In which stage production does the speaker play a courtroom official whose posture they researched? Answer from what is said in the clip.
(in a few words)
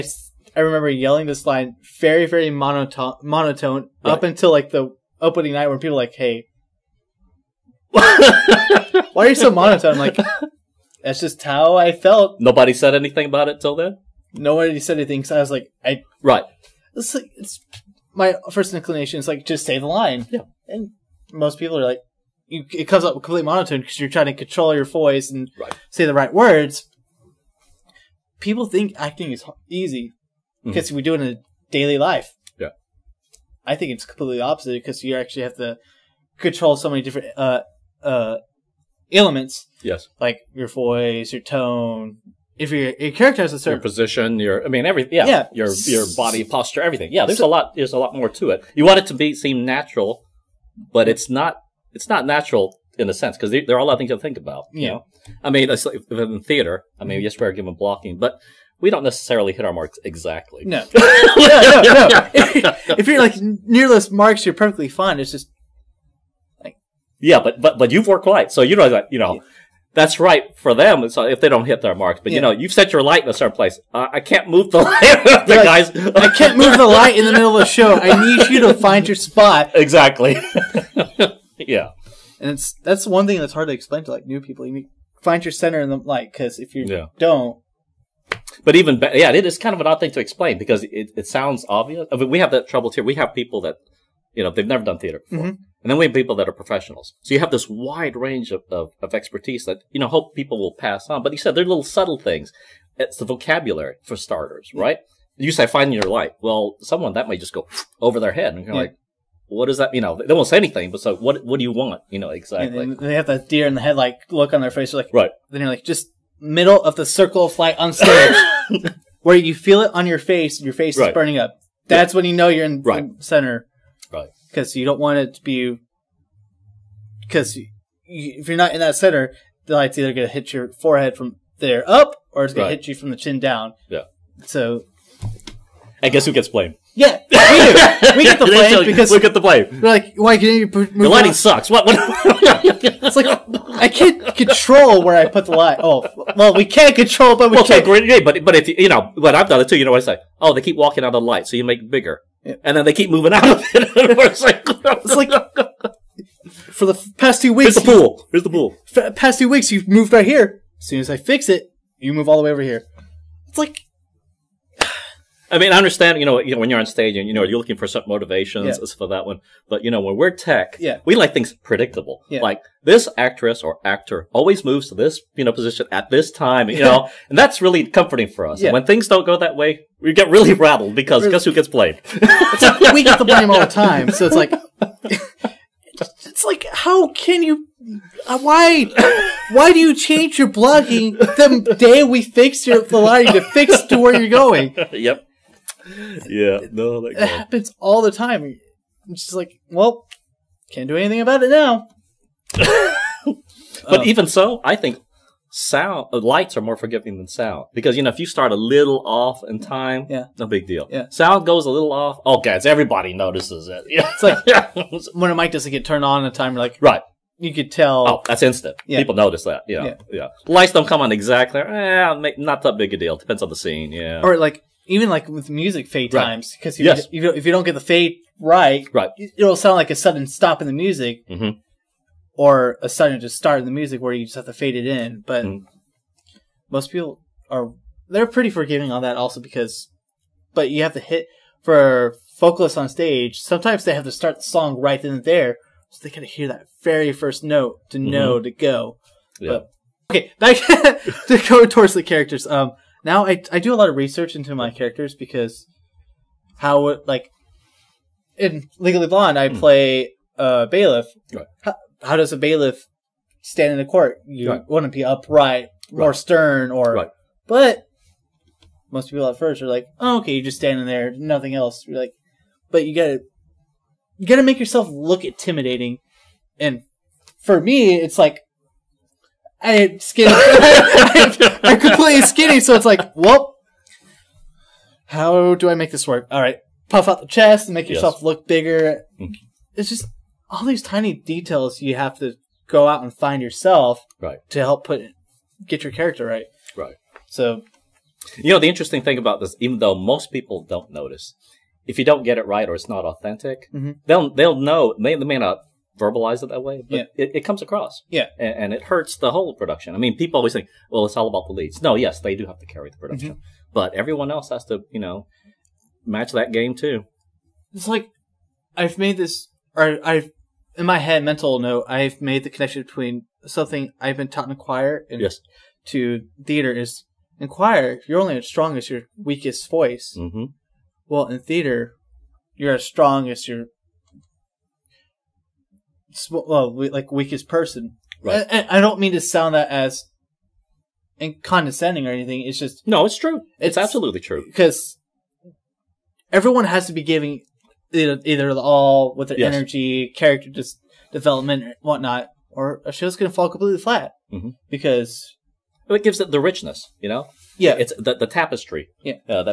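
Legally Blonde.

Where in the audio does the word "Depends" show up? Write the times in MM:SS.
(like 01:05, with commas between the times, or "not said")
03:43.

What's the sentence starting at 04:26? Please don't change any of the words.
or stern or but most people at first are like, oh, okay, you just standing there, nothing else.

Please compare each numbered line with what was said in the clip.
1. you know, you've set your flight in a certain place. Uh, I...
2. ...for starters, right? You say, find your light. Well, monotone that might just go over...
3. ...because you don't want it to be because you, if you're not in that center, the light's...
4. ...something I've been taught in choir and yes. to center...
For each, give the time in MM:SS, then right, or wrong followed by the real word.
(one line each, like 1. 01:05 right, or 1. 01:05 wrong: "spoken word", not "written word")
1. 01:12 wrong: "light", not "flight"
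2. 01:44 wrong: "someone", not "monotone"
3. 02:04 right
4. 05:23 wrong: "theater", not "center".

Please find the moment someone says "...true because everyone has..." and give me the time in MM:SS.
05:44.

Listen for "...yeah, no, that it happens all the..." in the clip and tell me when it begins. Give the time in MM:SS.
03:16.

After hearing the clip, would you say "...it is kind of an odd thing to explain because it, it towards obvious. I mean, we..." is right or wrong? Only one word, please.
wrong.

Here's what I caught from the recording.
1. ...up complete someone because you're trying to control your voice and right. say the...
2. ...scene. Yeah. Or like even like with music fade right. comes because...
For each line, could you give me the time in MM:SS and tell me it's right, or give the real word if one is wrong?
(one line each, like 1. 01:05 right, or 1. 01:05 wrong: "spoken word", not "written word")
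1. 00:23 wrong: "monotone", not "someone"
2. 03:43 wrong: "times", not "comes".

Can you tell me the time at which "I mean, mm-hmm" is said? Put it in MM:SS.
00:56.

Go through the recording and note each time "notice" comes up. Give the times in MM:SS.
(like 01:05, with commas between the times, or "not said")
03:33, 03:39, 05:00.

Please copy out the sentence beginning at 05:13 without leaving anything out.
but everyone else has to, you know, match that game too.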